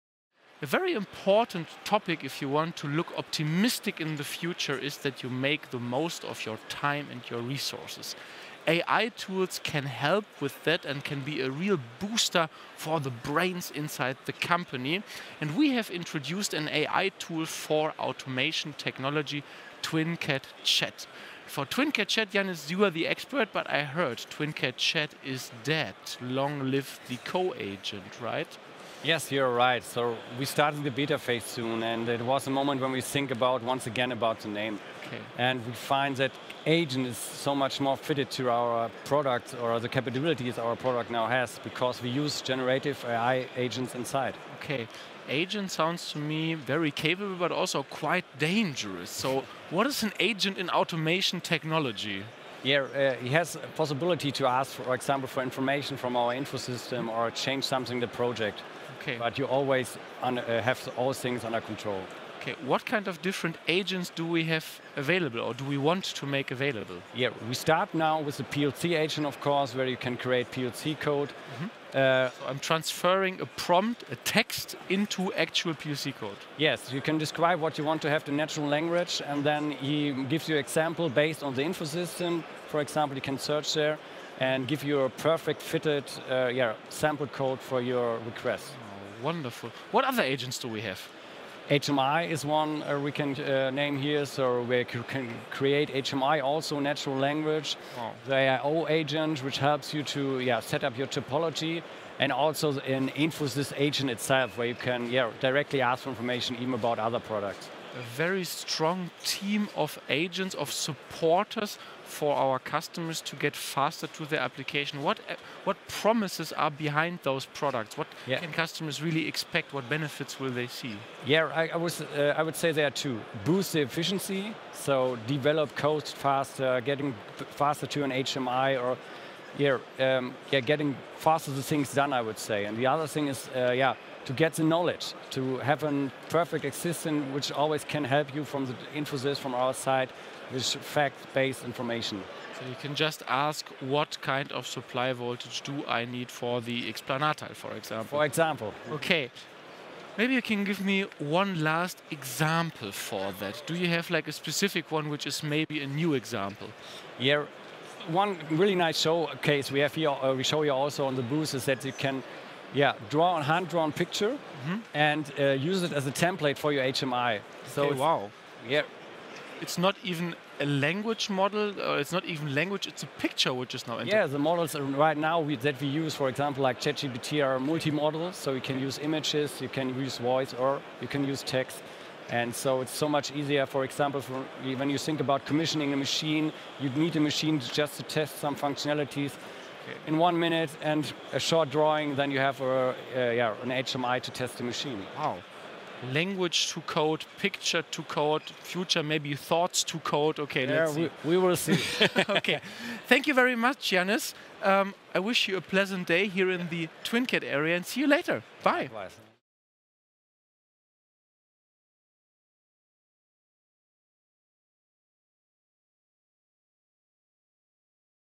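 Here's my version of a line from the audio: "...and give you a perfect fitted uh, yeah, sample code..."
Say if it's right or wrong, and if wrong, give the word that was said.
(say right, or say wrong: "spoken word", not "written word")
right.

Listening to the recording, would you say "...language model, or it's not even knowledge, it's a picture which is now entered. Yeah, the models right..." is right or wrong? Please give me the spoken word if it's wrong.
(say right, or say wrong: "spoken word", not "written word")
wrong: "language", not "knowledge".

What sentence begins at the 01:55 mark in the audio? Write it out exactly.
What what promises are behind those products?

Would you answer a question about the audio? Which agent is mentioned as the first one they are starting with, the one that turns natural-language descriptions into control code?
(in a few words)
PLC agent.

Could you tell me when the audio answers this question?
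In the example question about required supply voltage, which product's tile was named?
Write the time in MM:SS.
02:26.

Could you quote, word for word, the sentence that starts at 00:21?
For TwinCAT Chat, Janis, you are the expert, but I heard TwinCAT Chat is dead.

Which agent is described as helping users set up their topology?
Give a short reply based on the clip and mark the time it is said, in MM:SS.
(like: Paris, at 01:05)
IO agent, at 01:38.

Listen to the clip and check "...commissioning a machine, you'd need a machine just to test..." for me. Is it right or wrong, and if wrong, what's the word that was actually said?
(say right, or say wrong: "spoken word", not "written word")
right.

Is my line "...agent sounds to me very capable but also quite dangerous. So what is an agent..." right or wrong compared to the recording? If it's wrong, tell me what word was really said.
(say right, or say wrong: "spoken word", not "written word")
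right.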